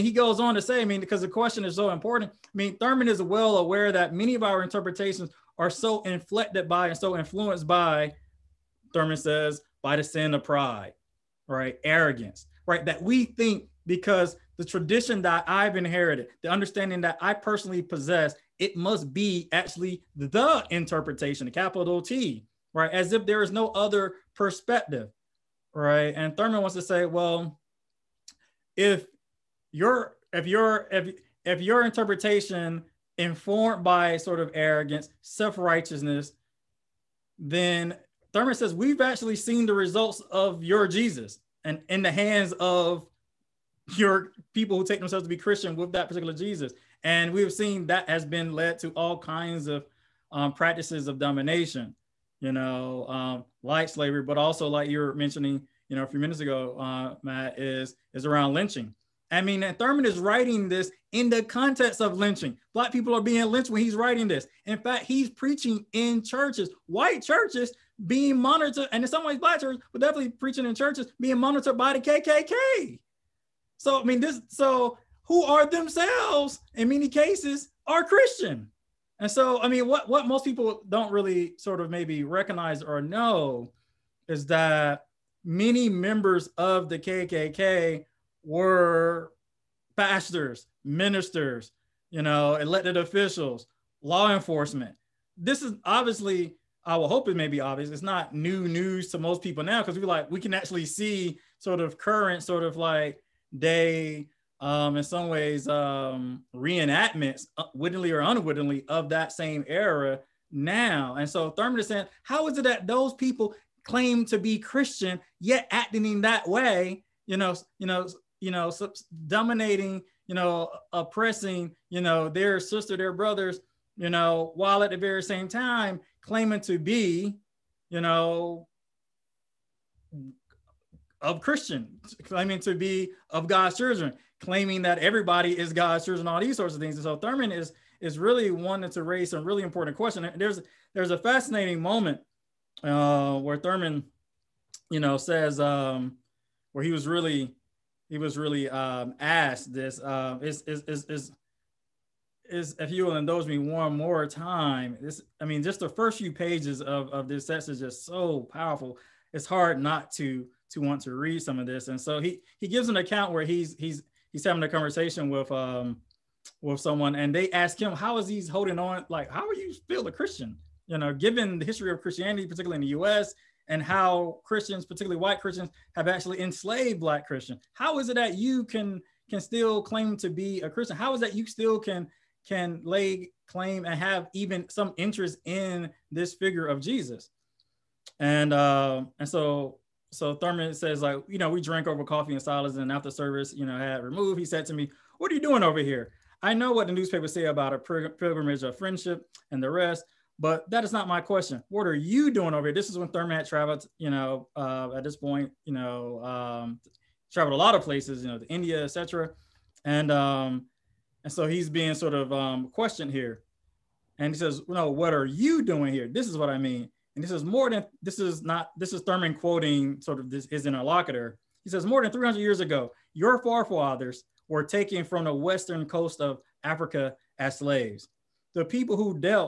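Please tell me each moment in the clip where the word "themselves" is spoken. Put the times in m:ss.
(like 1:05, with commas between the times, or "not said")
0:44, 1:15.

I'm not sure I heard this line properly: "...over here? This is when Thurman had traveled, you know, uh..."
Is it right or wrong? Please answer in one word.
right.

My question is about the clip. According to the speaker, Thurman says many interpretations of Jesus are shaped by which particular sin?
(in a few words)
pride.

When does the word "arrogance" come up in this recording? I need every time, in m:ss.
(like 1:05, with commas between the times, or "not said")
0:11, 0:34.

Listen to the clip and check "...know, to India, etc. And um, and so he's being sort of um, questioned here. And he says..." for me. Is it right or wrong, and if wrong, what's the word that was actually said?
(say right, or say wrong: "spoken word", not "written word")
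right.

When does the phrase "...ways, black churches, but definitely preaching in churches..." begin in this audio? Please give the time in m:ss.
1:09.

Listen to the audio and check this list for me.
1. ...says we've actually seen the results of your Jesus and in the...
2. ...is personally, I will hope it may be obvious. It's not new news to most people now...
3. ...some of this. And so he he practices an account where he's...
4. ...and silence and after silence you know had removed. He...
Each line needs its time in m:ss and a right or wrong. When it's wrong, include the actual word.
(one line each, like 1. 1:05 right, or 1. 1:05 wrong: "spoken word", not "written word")
1. 0:38 right
2. 1:35 wrong: "obviously", not "personally"
3. 2:41 wrong: "gives", not "practices"
4. 3:12 wrong: "service", not "silence".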